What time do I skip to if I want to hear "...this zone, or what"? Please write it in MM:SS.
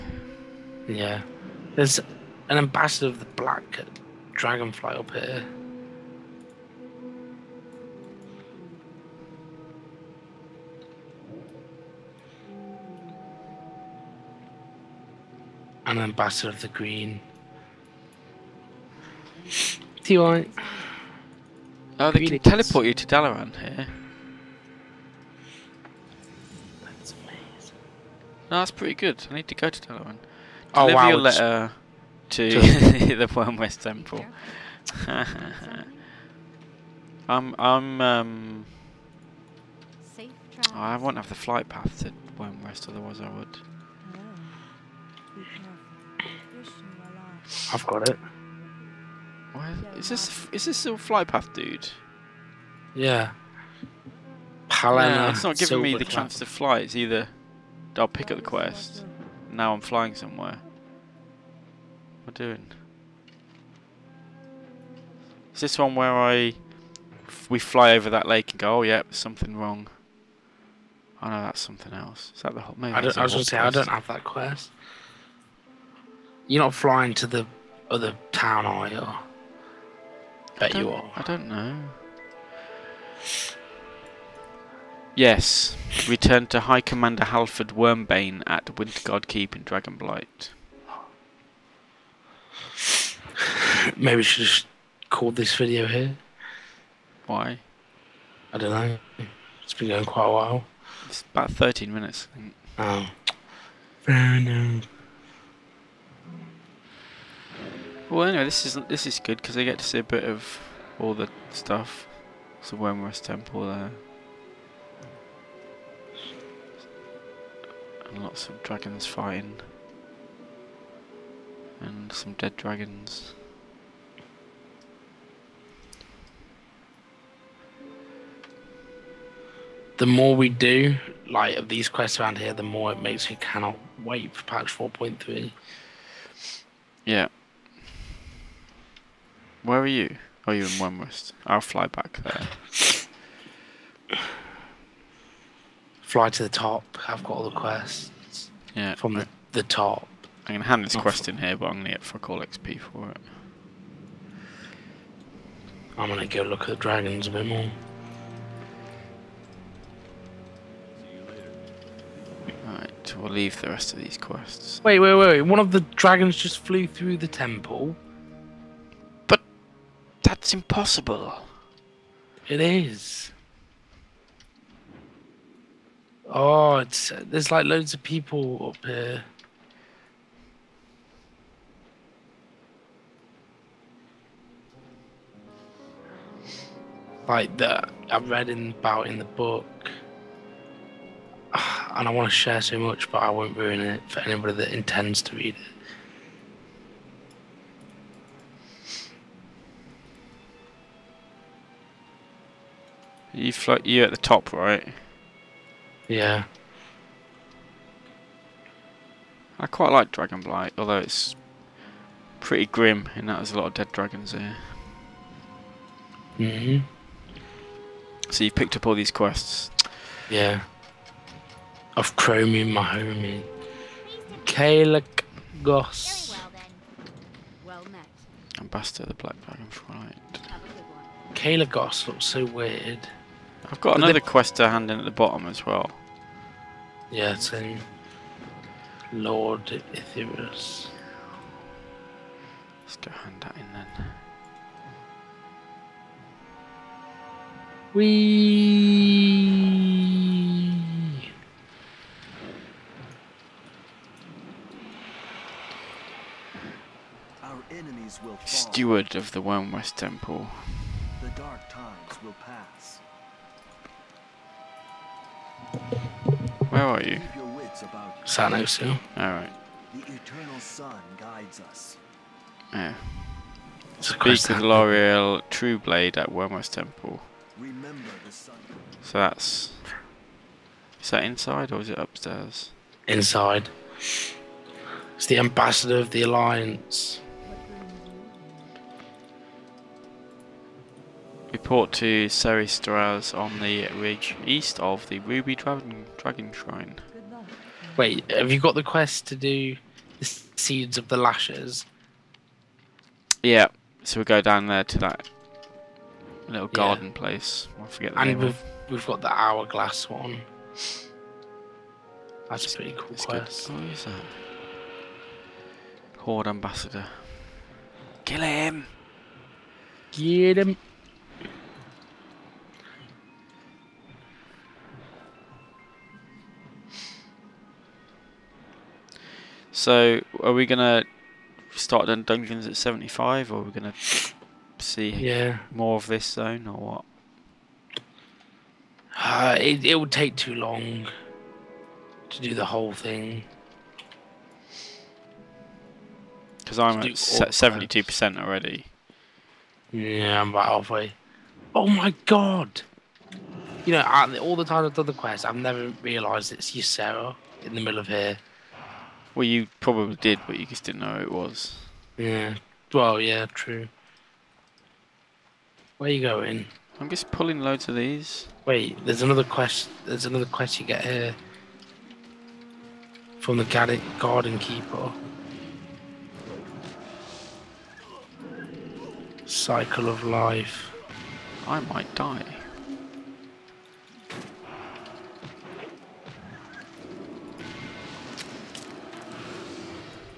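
05:36.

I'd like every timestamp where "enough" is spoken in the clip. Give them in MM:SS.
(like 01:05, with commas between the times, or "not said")
01:44.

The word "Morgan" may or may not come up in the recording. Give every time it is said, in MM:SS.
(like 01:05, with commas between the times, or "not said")
not said.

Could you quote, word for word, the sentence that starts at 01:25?
Yes, return to High Commander Halford Wormbane at Wintergarde Keep in Dragonblight.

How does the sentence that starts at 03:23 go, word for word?
You float you at the top, right?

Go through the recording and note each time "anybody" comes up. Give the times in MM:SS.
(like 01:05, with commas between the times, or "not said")
03:14.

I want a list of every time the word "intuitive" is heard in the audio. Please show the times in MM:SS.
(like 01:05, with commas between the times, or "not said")
not said.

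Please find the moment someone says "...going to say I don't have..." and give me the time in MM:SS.
01:13.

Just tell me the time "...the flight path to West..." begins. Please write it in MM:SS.
00:41.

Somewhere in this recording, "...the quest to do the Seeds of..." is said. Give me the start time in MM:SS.
04:58.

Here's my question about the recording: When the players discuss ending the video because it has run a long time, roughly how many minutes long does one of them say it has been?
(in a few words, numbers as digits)
13 minutes.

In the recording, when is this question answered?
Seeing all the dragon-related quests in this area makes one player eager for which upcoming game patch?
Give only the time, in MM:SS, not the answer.
02:14.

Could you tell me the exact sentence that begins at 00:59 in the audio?
Now I'm flying somewhere am I doing?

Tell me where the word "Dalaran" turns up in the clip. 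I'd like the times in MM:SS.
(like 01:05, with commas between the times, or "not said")
00:23, 00:29.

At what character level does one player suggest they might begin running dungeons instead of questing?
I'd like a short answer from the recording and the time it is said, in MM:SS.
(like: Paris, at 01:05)
75, at 05:32.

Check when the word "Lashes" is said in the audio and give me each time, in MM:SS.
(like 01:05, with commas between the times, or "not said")
05:01.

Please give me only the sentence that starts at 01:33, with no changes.
maybe we should just call this video here.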